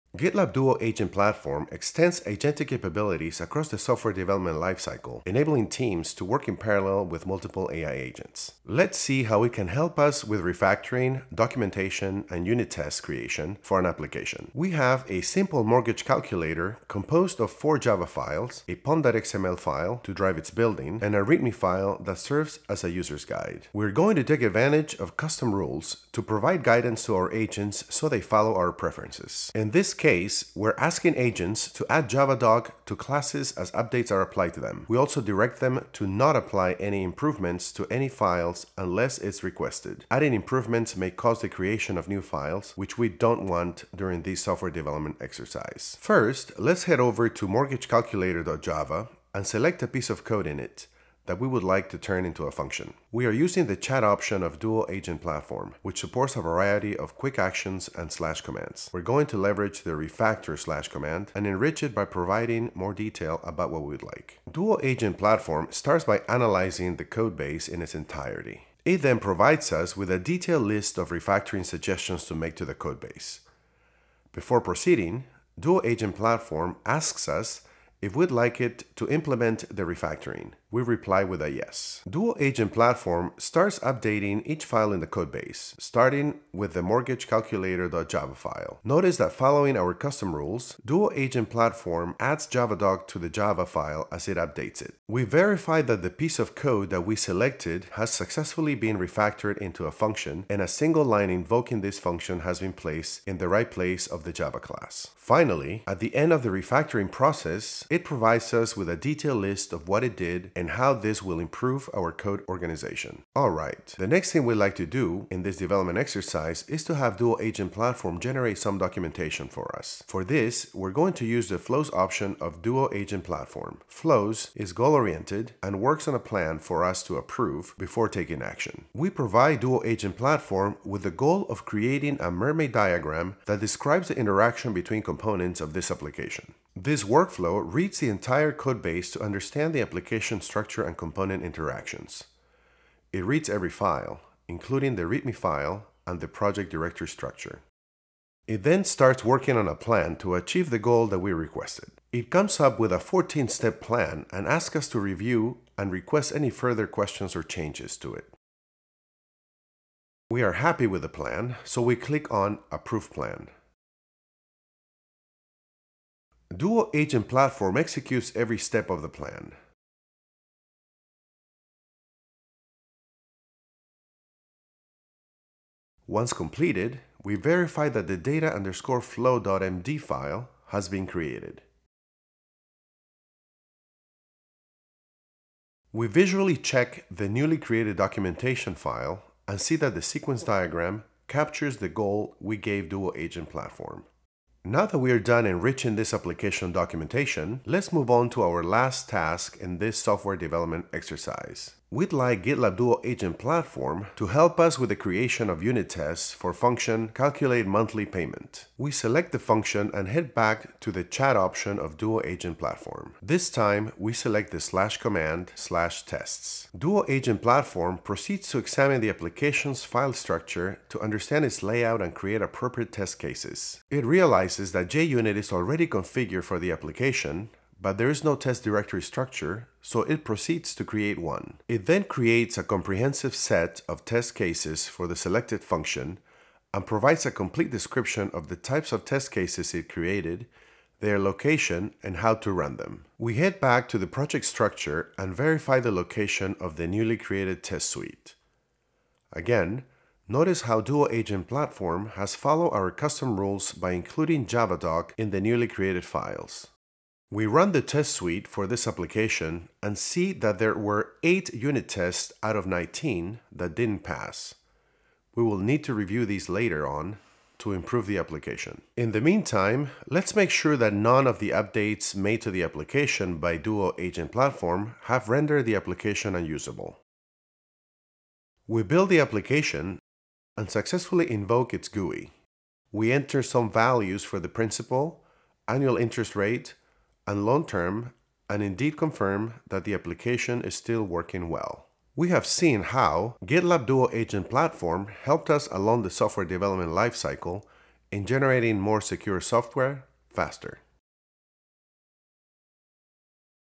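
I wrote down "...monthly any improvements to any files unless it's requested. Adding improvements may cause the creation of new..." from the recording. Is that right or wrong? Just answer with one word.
wrong.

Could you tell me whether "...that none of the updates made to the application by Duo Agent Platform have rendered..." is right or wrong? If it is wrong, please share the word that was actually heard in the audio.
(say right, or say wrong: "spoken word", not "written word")
right.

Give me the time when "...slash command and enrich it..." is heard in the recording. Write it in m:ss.
1:00.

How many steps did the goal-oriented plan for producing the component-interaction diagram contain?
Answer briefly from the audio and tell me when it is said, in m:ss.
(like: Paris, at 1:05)
14, at 2:32.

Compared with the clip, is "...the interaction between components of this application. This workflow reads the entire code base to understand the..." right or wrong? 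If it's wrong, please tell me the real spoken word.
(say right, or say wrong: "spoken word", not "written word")
right.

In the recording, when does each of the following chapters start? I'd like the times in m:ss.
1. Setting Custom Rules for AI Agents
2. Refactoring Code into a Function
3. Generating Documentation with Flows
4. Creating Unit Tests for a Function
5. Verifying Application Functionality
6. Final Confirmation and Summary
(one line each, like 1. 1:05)
1. 0:26
2. 0:50
3. 1:53
4. 3:33
5. 4:25
6. 4:42.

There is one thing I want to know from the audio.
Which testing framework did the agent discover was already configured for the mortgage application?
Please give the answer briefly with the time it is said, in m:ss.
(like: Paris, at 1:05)
JUnit, at 3:44.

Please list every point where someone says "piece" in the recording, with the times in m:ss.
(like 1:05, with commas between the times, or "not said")
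0:49, 1:36.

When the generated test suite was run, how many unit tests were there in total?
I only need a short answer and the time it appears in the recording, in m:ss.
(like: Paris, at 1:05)
19, at 4:22.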